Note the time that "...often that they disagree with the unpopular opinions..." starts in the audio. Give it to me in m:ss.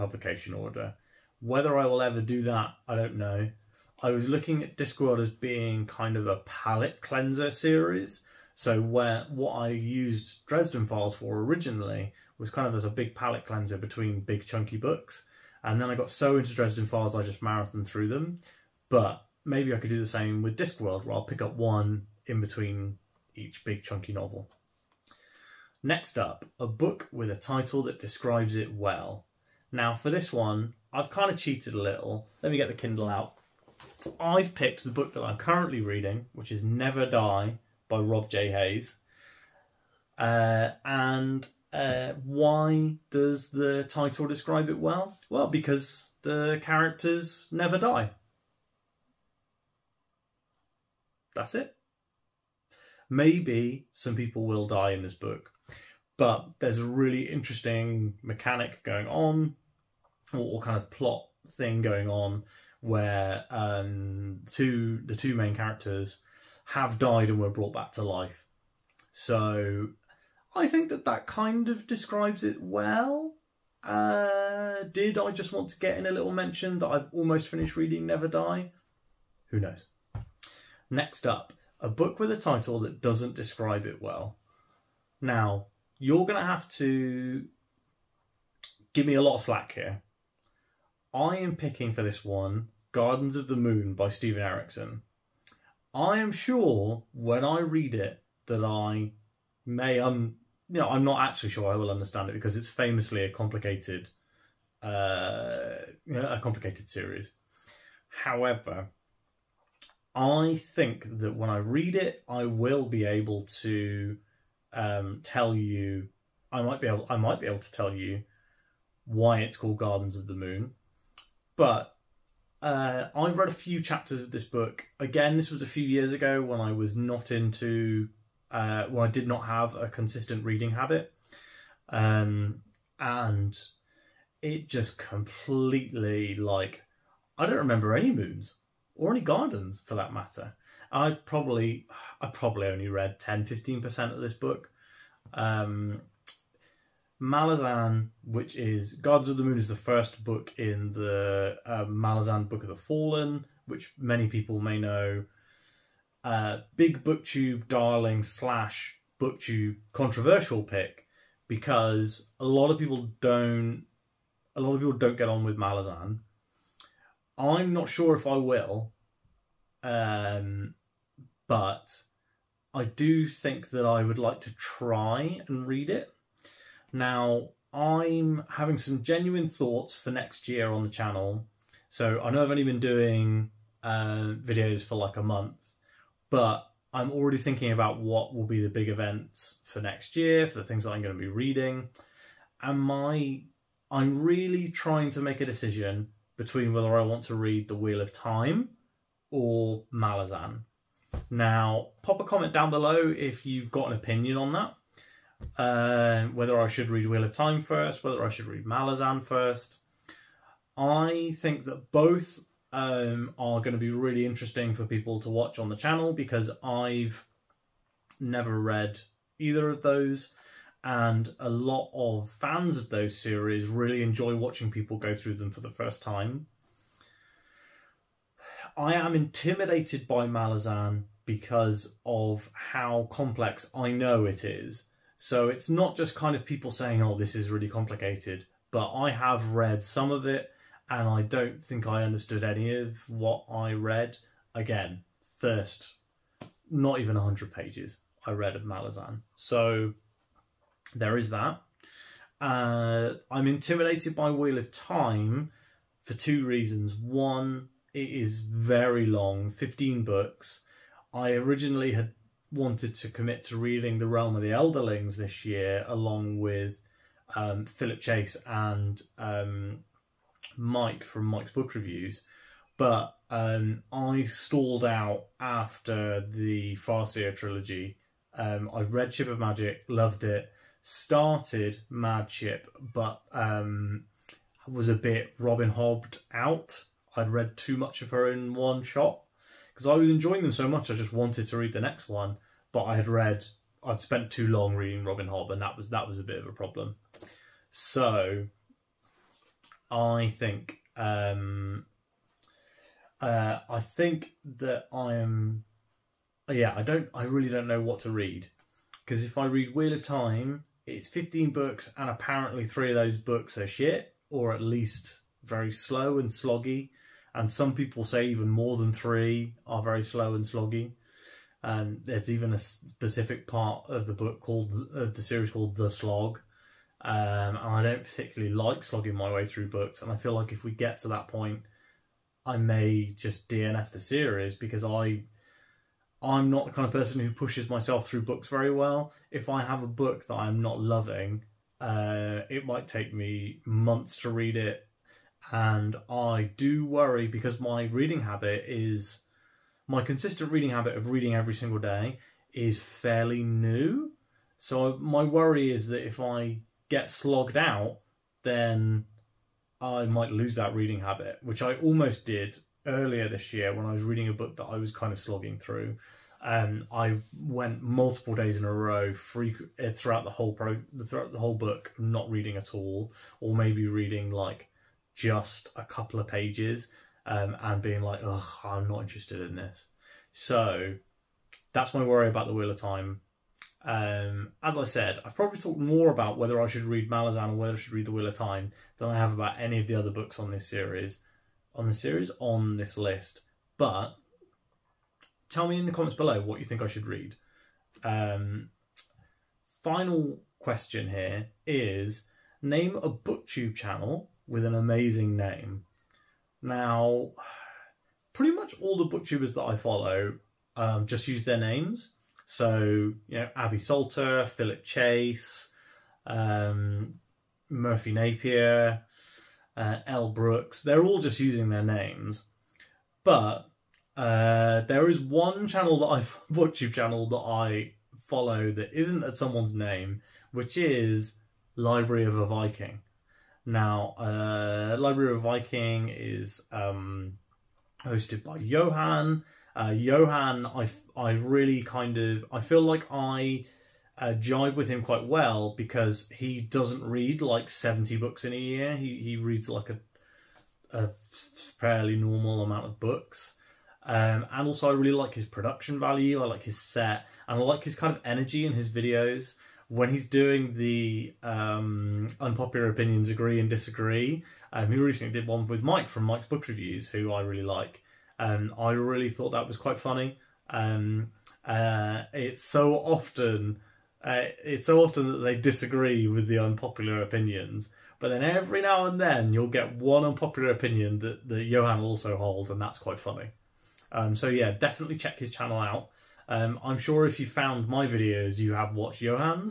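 7:55.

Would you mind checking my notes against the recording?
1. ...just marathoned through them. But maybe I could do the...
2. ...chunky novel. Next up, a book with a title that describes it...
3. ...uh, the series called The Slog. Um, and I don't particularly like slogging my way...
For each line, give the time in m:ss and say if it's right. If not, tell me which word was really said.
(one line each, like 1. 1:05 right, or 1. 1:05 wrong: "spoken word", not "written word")
1. 0:17 right
2. 0:23 right
3. 5:24 right.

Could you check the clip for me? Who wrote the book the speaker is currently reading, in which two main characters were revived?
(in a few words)
Rob J. Hayes.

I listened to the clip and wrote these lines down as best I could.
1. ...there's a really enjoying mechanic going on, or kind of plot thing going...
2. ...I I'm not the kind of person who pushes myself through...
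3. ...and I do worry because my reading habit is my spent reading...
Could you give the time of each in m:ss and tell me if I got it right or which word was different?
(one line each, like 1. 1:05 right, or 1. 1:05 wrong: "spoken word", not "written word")
1. 0:56 wrong: "interesting", not "enjoying"
2. 5:34 right
3. 5:45 wrong: "consistent", not "spent".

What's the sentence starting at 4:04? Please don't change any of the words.
Again, first, not even 100 pages I read of Malazan.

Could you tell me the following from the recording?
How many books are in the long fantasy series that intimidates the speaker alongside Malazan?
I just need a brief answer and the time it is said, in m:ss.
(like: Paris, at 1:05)
15, at 4:19.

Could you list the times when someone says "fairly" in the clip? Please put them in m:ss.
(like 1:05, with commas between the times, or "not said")
5:52, 7:31.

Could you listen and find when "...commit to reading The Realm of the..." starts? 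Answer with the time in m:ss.
4:23.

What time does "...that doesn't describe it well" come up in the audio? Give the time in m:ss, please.
1:22.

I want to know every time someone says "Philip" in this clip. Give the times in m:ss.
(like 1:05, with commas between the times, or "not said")
4:27, 6:54.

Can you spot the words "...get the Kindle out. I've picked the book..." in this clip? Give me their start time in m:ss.
0:32.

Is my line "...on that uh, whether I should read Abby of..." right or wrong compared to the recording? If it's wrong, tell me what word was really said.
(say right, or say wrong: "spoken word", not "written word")
wrong: "Wheel", not "Abby".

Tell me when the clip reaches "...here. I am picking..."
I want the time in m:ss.
1:29.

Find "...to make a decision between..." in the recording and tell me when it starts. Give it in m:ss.
3:15.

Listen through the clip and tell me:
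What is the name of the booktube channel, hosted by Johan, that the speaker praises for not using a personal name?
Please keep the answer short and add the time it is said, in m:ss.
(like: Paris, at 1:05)
Library of a Viking, at 7:11.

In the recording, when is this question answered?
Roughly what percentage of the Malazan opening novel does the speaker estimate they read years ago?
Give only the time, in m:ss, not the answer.
2:23.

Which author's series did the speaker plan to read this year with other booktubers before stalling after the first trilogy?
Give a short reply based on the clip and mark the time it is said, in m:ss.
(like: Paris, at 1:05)
Robin Hobb, at 4:55.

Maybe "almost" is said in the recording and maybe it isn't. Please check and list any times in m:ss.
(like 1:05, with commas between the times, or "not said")
1:17, 6:01.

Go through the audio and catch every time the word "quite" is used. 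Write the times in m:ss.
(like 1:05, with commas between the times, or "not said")
7:25, 7:49, 8:02.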